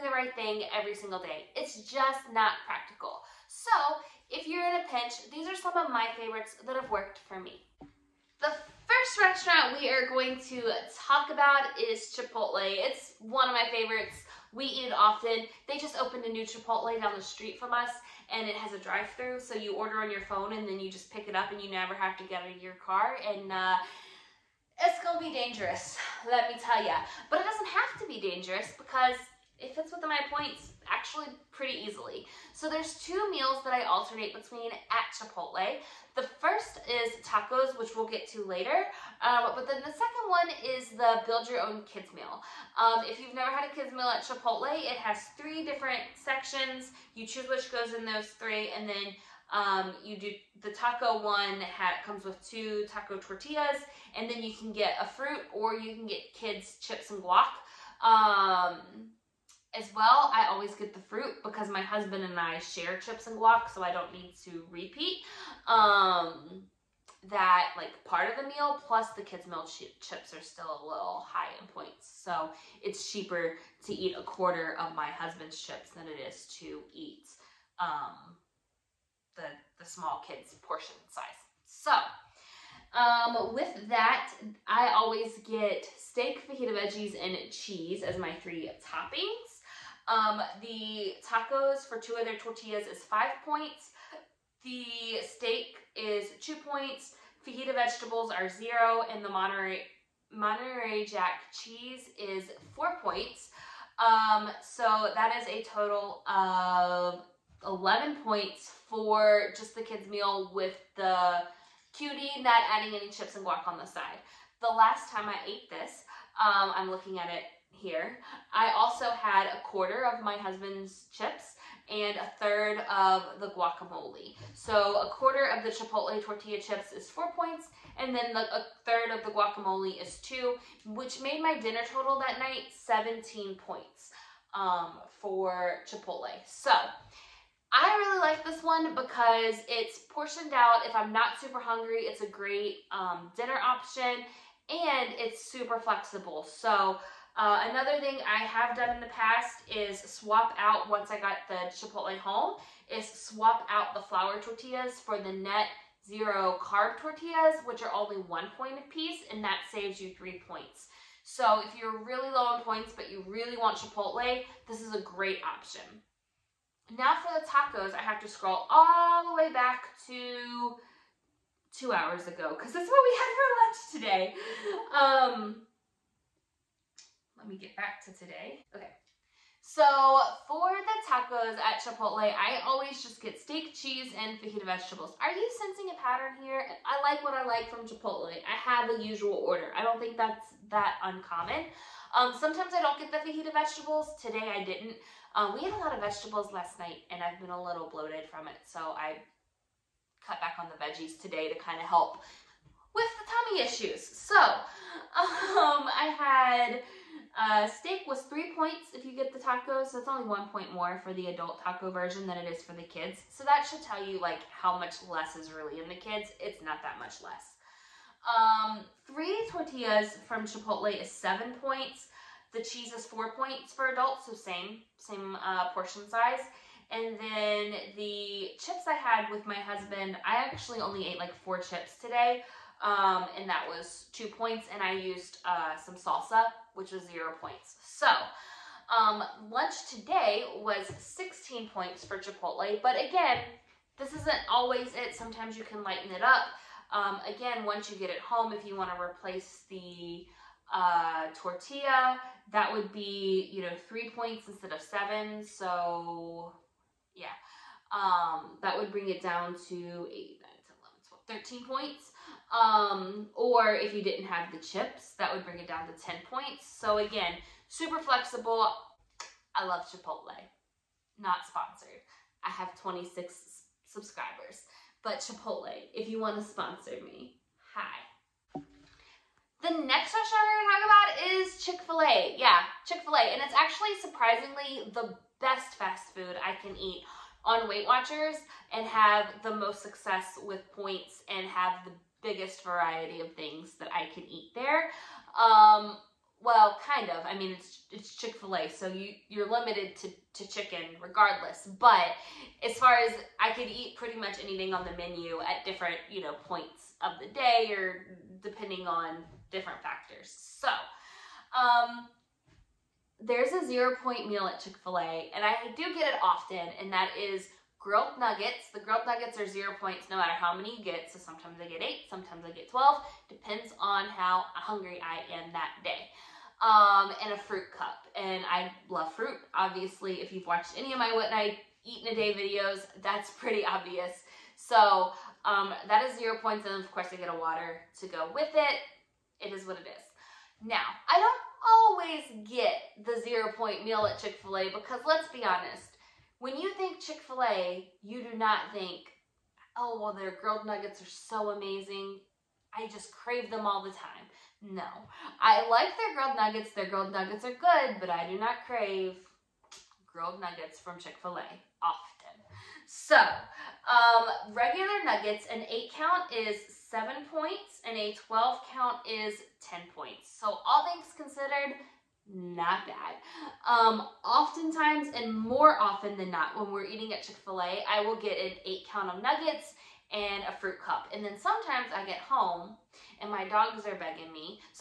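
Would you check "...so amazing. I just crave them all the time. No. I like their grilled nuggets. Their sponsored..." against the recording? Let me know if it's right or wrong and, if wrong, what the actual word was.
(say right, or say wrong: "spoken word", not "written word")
wrong: "grilled", not "sponsored".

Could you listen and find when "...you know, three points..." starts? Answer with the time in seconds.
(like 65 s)
253 s.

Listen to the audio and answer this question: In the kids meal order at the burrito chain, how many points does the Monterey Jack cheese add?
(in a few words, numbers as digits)
4.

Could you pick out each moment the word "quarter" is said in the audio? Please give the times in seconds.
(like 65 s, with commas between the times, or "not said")
74 s, 119 s, 125 s.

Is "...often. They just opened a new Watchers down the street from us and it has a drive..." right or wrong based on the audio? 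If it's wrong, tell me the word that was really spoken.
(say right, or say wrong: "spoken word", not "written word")
wrong: "Chipotle", not "Watchers".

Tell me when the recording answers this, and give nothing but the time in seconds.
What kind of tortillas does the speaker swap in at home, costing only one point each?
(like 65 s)
155 s.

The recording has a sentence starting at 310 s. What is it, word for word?
So, um, there's a zero point meal at Chick Fil A, and I do get it often, and that is grilled nuggets.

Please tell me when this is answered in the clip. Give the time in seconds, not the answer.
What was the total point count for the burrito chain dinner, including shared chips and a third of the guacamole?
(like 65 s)
132 s.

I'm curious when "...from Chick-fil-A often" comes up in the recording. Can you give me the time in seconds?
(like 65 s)
360 s.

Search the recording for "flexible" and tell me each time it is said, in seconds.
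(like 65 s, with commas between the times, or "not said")
145 s, 267 s.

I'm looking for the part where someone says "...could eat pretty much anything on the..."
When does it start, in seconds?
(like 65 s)
303 s.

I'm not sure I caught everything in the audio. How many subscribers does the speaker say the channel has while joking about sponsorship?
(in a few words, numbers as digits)
26.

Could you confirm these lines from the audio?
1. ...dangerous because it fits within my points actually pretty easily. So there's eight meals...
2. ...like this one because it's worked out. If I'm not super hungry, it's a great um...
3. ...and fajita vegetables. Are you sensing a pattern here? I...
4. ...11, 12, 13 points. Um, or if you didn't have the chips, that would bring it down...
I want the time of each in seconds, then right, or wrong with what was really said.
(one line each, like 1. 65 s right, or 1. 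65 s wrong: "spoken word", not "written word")
1. 28 s wrong: "two", not "eight"
2. 138 s wrong: "portioned", not "worked"
3. 184 s right
4. 261 s right.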